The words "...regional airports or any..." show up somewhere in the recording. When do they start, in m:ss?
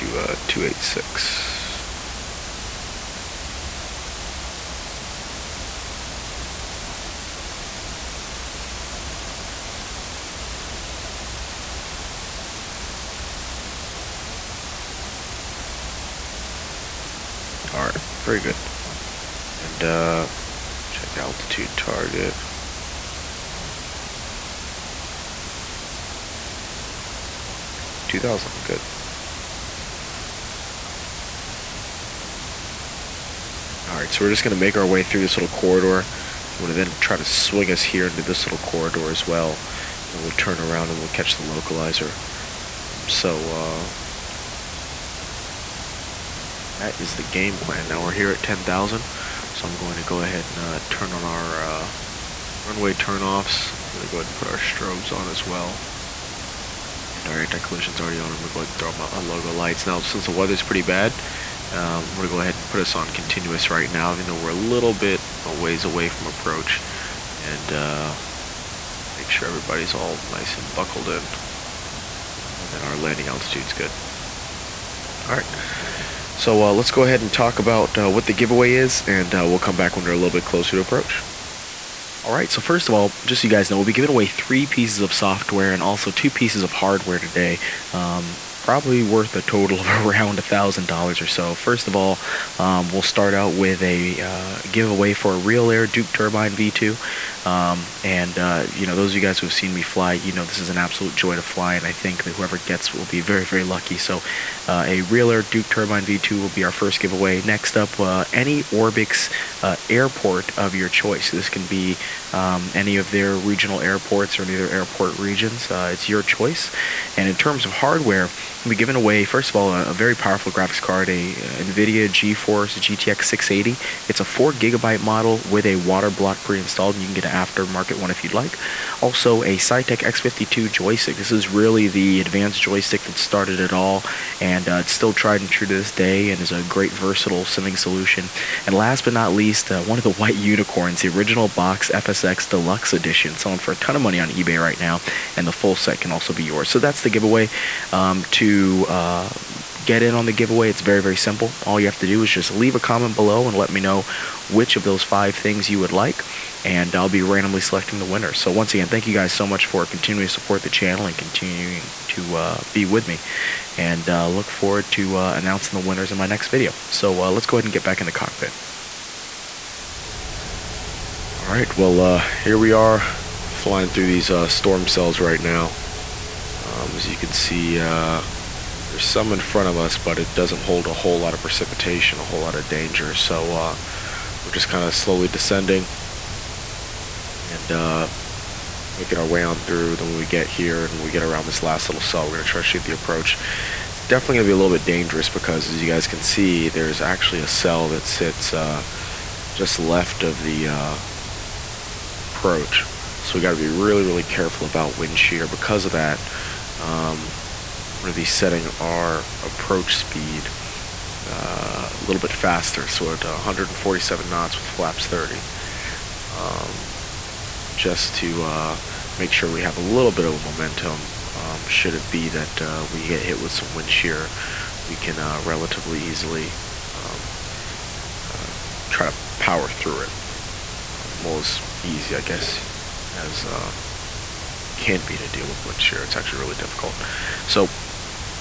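1:53.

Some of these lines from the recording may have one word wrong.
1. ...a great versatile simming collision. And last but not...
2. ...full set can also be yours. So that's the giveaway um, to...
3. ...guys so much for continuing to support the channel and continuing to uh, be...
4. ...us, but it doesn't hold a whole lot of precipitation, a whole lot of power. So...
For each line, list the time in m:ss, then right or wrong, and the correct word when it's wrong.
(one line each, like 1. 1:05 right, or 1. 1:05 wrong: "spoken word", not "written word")
1. 2:16 wrong: "solution", not "collision"
2. 2:25 right
3. 2:39 right
4. 2:59 wrong: "danger", not "power".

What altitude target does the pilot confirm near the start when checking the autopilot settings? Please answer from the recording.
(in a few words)
2000.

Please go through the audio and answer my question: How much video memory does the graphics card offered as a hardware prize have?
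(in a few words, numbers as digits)
4 gigabytes.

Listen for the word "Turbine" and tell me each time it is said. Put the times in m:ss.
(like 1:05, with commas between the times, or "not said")
1:36, 1:45.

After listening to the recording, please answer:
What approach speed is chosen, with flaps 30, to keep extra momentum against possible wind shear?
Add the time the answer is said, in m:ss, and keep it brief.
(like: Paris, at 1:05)
147 knots, at 3:33.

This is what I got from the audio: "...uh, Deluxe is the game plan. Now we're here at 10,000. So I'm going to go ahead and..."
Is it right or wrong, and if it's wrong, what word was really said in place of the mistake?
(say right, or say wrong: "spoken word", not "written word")
wrong: "That", not "Deluxe".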